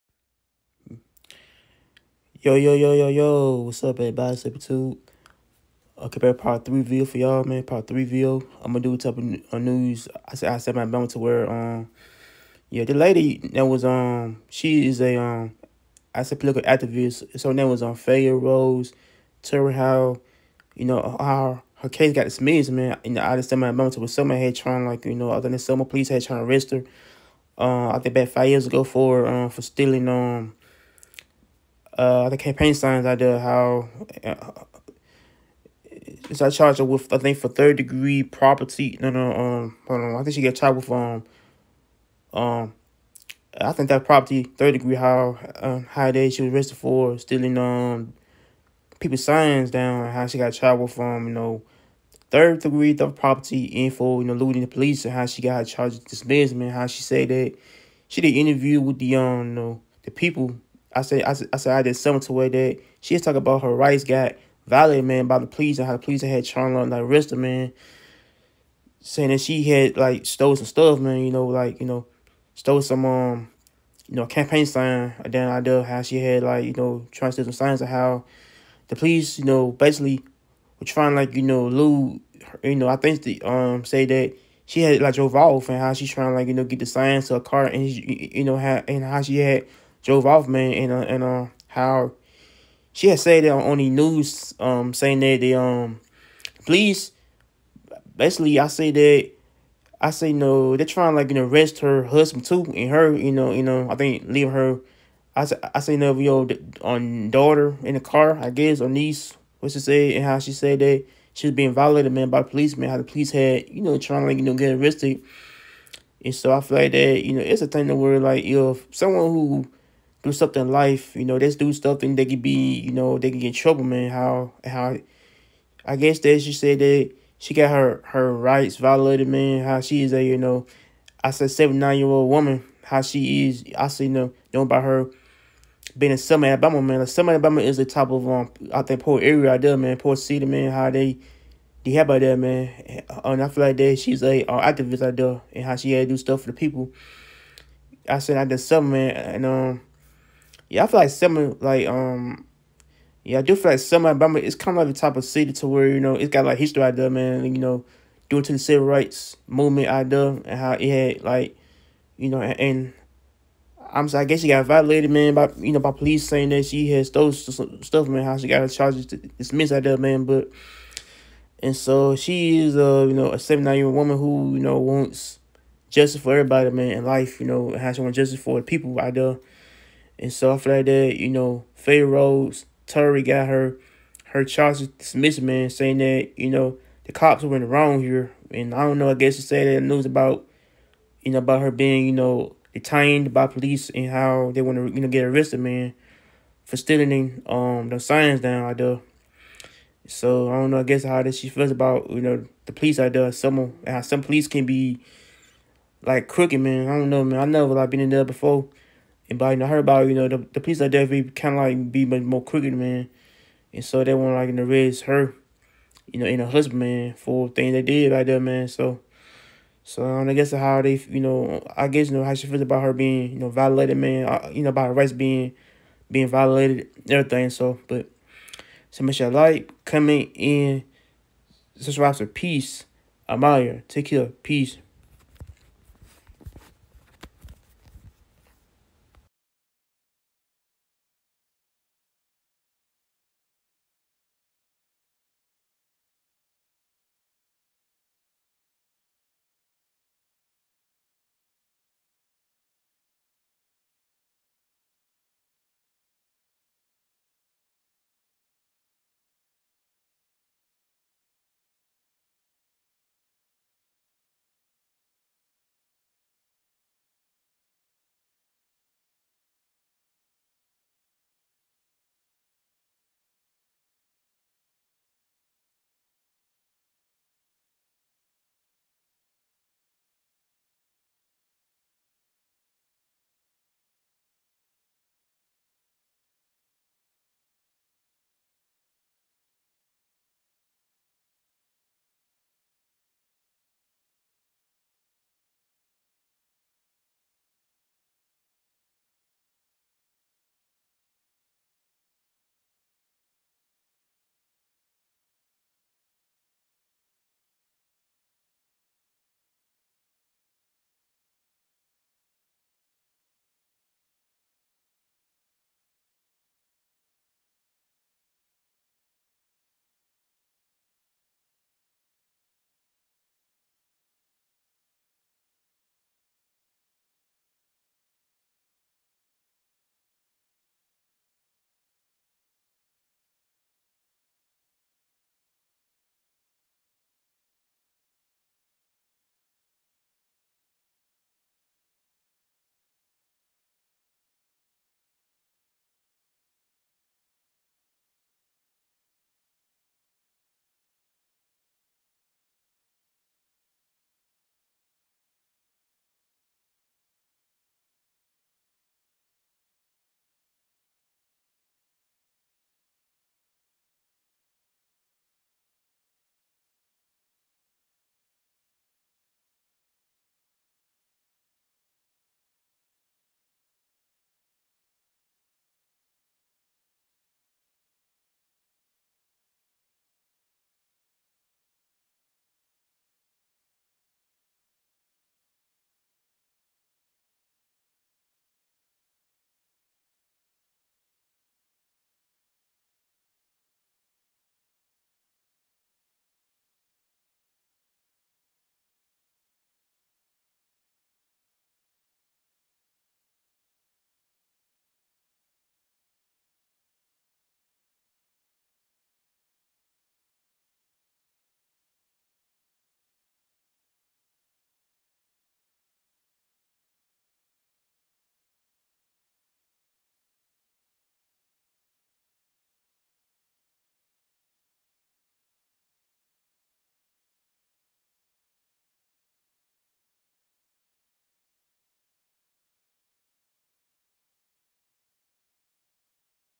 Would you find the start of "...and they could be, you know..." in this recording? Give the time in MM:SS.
02:02.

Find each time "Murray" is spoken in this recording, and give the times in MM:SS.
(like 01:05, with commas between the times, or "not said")
not said.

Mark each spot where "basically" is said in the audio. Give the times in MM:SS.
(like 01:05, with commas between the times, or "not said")
01:19, 01:38.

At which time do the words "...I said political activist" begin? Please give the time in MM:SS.
00:16.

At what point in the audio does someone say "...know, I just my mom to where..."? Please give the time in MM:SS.
00:23.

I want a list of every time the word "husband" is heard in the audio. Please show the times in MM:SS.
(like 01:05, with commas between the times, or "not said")
01:42, 03:36.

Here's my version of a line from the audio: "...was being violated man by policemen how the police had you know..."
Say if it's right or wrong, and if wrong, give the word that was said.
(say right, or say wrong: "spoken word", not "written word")
right.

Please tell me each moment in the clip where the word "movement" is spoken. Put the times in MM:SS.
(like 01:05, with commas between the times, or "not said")
02:39.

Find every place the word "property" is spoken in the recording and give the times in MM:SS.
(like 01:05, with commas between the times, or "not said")
00:38, 00:44, 00:53.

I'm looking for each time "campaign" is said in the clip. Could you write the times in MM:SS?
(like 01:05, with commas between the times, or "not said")
00:32, 01:14.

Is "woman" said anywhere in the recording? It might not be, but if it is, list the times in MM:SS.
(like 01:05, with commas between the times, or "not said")
02:12, 02:53.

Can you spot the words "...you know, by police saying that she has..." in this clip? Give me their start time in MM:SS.
02:45.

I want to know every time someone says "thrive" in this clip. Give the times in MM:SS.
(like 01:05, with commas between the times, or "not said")
not said.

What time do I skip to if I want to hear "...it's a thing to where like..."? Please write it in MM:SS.
01:57.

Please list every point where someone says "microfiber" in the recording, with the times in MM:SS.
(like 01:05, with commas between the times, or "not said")
not said.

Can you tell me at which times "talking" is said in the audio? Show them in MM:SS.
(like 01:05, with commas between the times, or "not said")
01:03.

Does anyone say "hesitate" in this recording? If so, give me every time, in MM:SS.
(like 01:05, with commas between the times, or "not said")
not said.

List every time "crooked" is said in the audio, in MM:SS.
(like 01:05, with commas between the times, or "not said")
03:26, 03:32.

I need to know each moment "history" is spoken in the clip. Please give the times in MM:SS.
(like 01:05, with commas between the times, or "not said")
02:36.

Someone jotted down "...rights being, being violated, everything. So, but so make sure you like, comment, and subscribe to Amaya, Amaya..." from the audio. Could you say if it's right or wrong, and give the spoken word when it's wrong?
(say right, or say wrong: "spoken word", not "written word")
wrong: "Peace", not "Amaya".